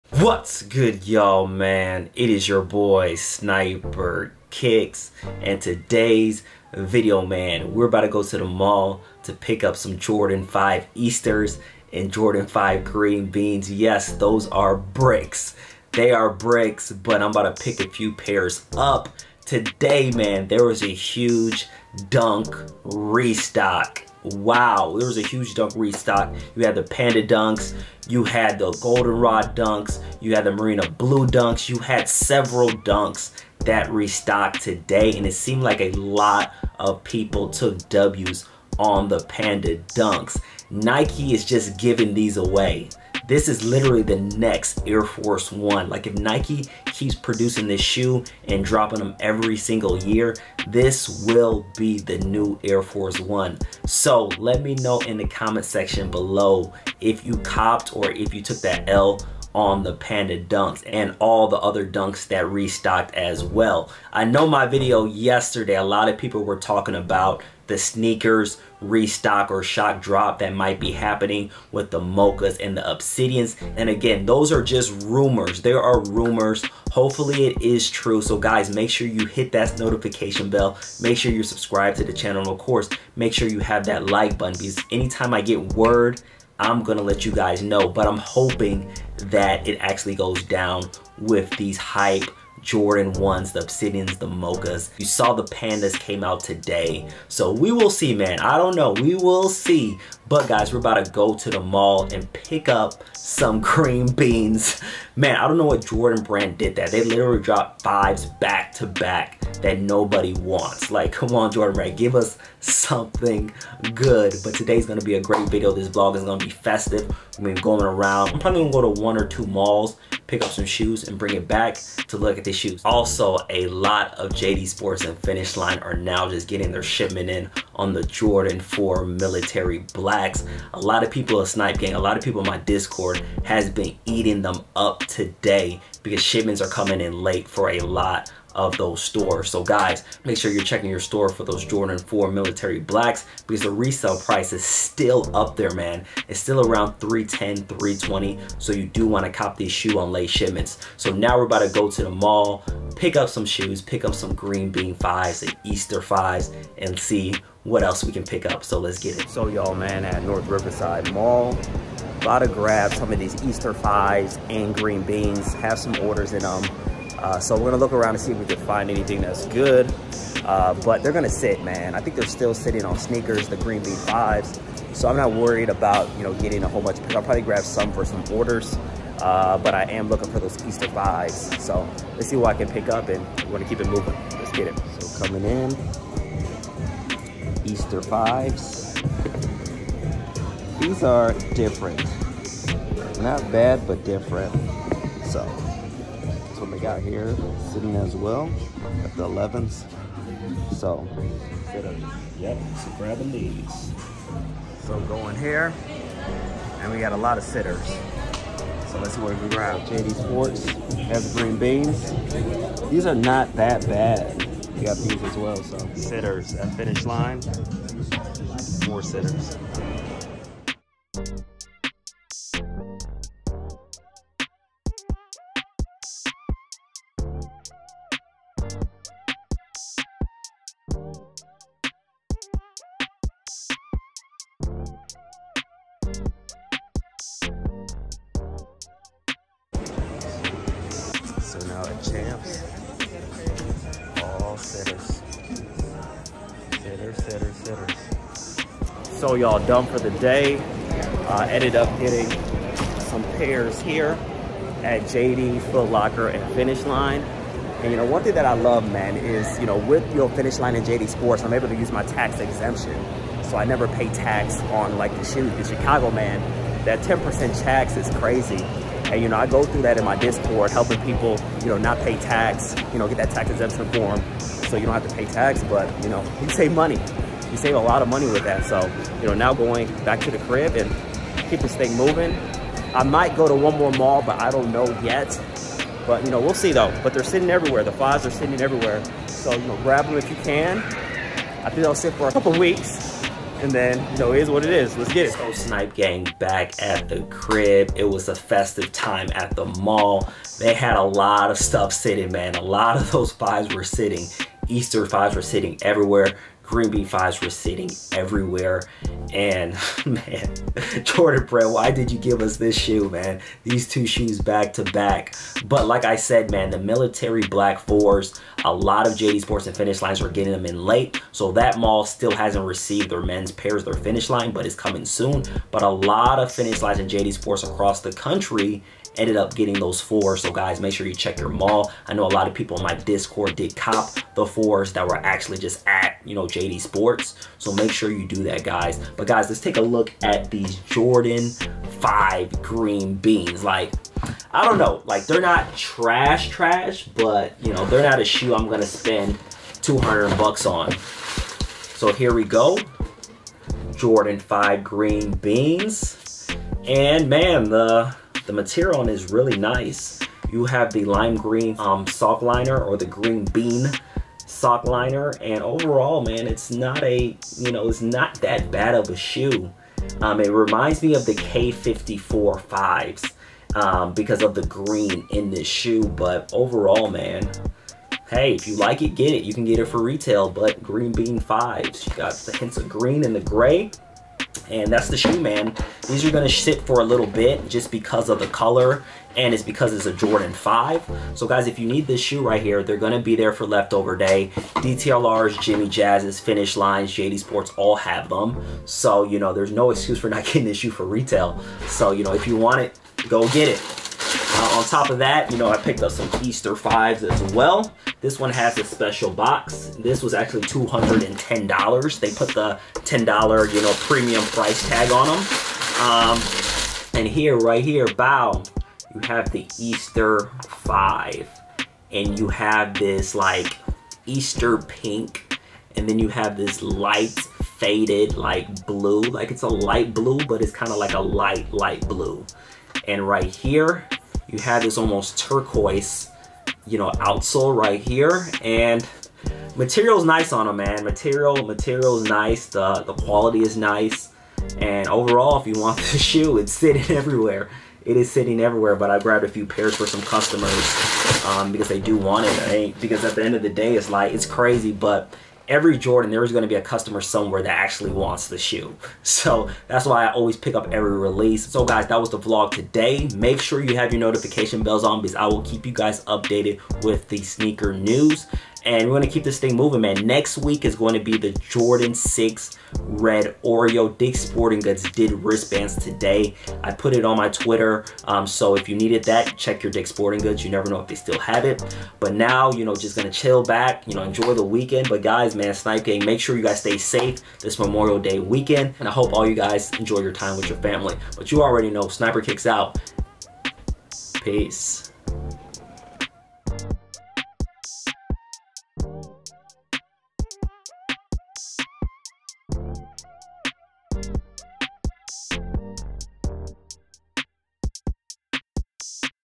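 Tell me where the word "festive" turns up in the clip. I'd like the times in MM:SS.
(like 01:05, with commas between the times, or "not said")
01:56, 04:58.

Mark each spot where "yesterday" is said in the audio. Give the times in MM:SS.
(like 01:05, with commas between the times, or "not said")
01:05.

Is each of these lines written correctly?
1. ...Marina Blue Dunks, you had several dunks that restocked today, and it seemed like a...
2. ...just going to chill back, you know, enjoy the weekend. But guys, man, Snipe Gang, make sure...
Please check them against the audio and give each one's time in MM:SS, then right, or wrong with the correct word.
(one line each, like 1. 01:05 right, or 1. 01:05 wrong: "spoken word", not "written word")
1. 00:30 right
2. 08:02 right.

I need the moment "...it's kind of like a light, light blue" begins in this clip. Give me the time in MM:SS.
07:10.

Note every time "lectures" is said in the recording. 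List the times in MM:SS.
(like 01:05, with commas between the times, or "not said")
not said.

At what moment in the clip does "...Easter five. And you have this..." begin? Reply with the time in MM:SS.
06:59.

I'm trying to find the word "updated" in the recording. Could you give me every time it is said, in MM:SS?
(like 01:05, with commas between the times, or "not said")
07:46.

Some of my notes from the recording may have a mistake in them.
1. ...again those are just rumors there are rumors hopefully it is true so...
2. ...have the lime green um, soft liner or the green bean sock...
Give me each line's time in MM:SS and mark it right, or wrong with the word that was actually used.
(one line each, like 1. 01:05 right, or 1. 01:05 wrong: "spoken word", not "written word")
1. 01:13 right
2. 06:00 right.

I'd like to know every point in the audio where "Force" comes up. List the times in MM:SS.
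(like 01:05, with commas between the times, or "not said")
00:45, 00:52.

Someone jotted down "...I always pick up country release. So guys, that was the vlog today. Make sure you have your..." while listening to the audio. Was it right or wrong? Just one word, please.
wrong.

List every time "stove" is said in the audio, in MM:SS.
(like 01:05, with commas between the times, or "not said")
not said.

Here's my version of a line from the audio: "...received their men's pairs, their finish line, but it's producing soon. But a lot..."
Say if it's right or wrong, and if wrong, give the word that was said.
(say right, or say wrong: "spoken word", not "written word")
wrong: "coming", not "producing".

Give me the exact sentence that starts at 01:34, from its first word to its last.
You saw the Pandas came out today.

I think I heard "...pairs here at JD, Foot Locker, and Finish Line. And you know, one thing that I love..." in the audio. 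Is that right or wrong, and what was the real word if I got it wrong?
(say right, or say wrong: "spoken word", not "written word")
right.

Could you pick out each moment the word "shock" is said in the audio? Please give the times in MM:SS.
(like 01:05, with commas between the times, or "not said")
01:09.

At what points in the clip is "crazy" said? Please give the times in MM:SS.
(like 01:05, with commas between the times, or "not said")
04:28, 07:34.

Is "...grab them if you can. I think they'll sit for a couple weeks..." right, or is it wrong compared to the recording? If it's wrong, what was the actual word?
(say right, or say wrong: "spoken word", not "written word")
right.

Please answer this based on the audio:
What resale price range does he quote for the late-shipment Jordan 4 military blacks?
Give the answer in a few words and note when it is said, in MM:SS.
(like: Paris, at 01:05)
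310-320, at 02:26.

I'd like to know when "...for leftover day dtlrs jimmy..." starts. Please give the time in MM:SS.
06:33.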